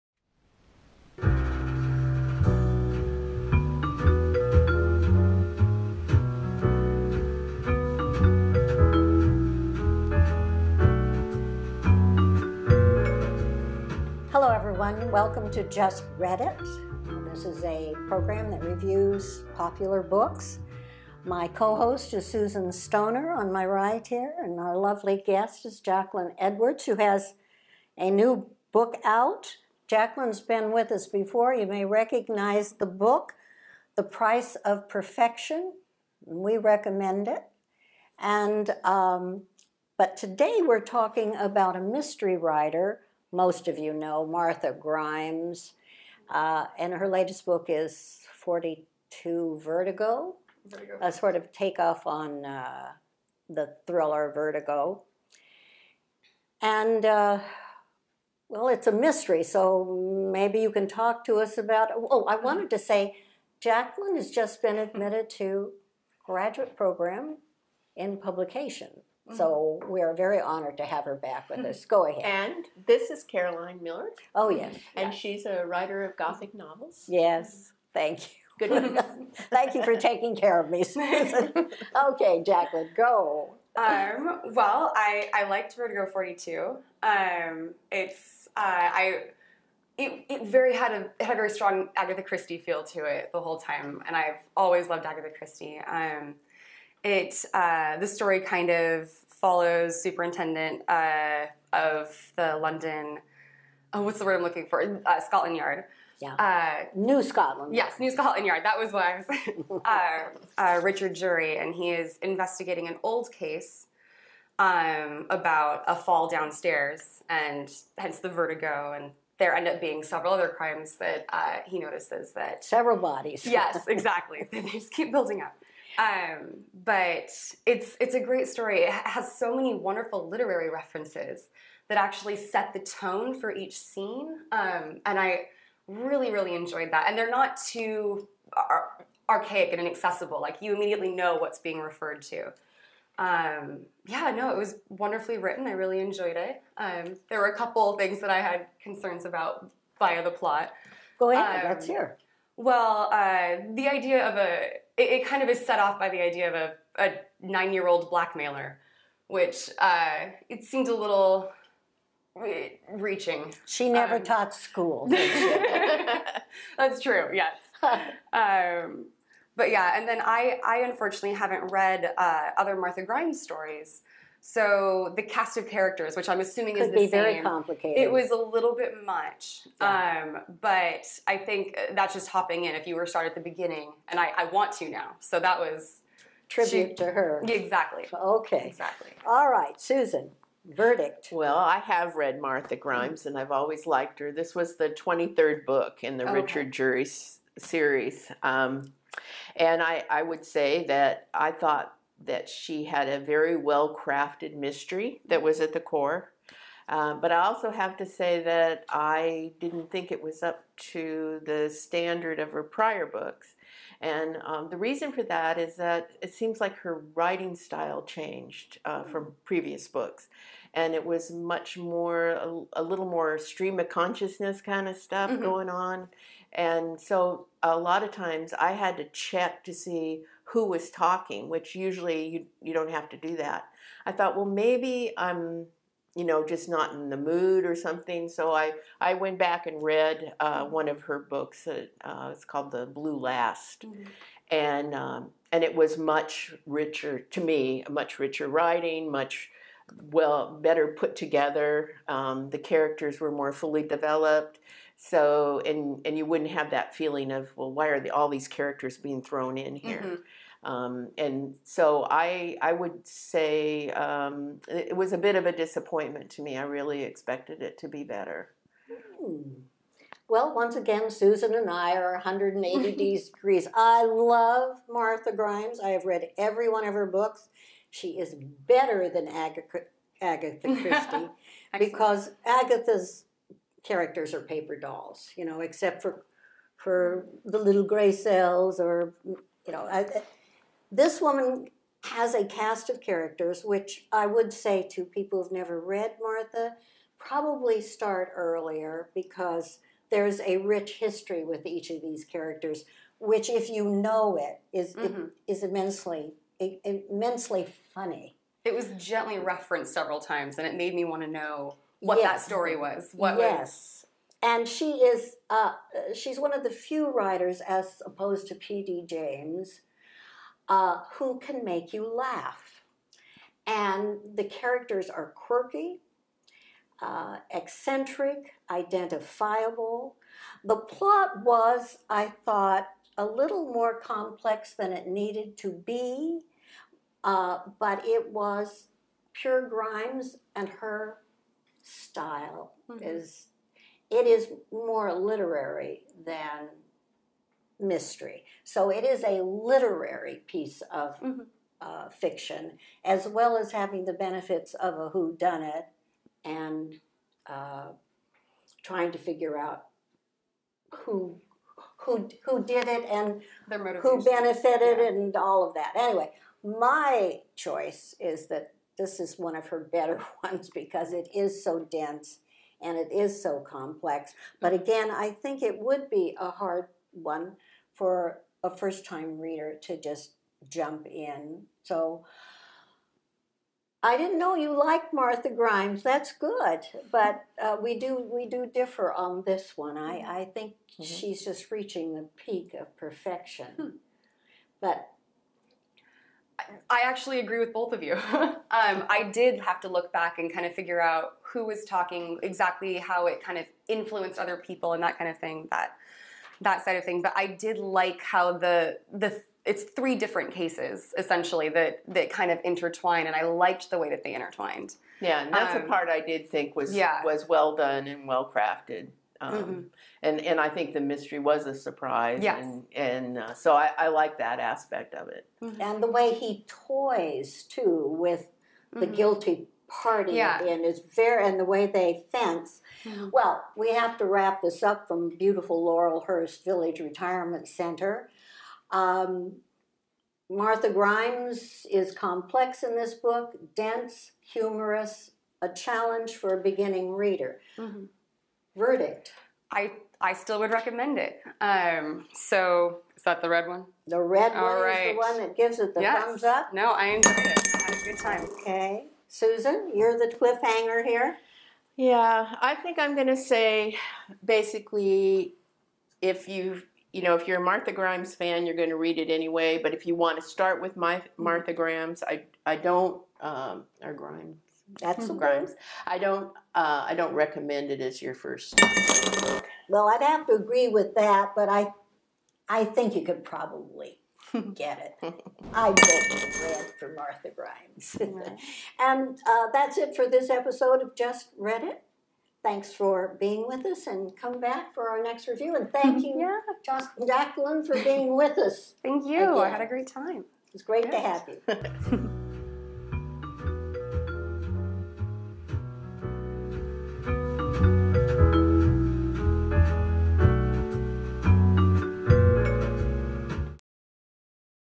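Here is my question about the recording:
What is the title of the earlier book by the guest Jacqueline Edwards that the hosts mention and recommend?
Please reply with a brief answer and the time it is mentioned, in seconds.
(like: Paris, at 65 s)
The Price of Perfection, at 33 s.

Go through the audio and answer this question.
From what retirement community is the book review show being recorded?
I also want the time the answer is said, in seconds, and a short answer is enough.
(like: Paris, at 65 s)
Laurelhurst Village Retirement Center, at 435 s.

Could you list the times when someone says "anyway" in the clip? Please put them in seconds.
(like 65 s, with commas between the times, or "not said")
365 s, 469 s.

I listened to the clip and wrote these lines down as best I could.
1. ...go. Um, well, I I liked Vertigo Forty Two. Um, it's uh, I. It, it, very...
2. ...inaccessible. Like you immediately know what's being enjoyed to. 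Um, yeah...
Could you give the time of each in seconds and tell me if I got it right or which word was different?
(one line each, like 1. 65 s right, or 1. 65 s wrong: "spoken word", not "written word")
1. 82 s right
2. 139 s wrong: "referred", not "enjoyed".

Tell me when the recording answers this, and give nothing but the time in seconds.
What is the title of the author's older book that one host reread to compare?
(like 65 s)
242 s.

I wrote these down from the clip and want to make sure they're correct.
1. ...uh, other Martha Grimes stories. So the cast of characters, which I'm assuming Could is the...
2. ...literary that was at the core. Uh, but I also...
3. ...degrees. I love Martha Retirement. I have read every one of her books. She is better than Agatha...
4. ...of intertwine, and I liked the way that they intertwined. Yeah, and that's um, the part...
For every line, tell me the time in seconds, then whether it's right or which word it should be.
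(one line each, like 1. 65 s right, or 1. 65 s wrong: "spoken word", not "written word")
1. 172 s right
2. 204 s wrong: "mystery", not "literary"
3. 273 s wrong: "Grimes", not "Retirement"
4. 412 s right.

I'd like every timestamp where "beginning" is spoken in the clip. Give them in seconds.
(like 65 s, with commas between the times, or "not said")
183 s, 446 s.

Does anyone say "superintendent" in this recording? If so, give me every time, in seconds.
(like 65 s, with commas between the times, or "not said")
100 s.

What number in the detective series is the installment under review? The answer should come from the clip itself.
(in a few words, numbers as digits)
23rd.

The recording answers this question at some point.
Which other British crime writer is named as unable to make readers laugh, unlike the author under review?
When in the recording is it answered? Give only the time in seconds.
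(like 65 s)
318 s.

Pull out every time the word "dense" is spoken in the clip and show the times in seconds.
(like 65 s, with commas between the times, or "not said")
371 s, 443 s.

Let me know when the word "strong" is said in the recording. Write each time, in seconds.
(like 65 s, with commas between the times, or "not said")
91 s.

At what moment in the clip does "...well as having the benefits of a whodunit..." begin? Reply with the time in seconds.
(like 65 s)
353 s.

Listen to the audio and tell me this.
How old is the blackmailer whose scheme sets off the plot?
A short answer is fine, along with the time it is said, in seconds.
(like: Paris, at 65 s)
9, at 157 s.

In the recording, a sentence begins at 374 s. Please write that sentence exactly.
But again, I think it would be a hard one for a first time reader to just jump in.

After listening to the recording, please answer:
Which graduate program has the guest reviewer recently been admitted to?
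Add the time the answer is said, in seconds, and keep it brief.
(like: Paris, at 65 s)
Publication, at 68 s.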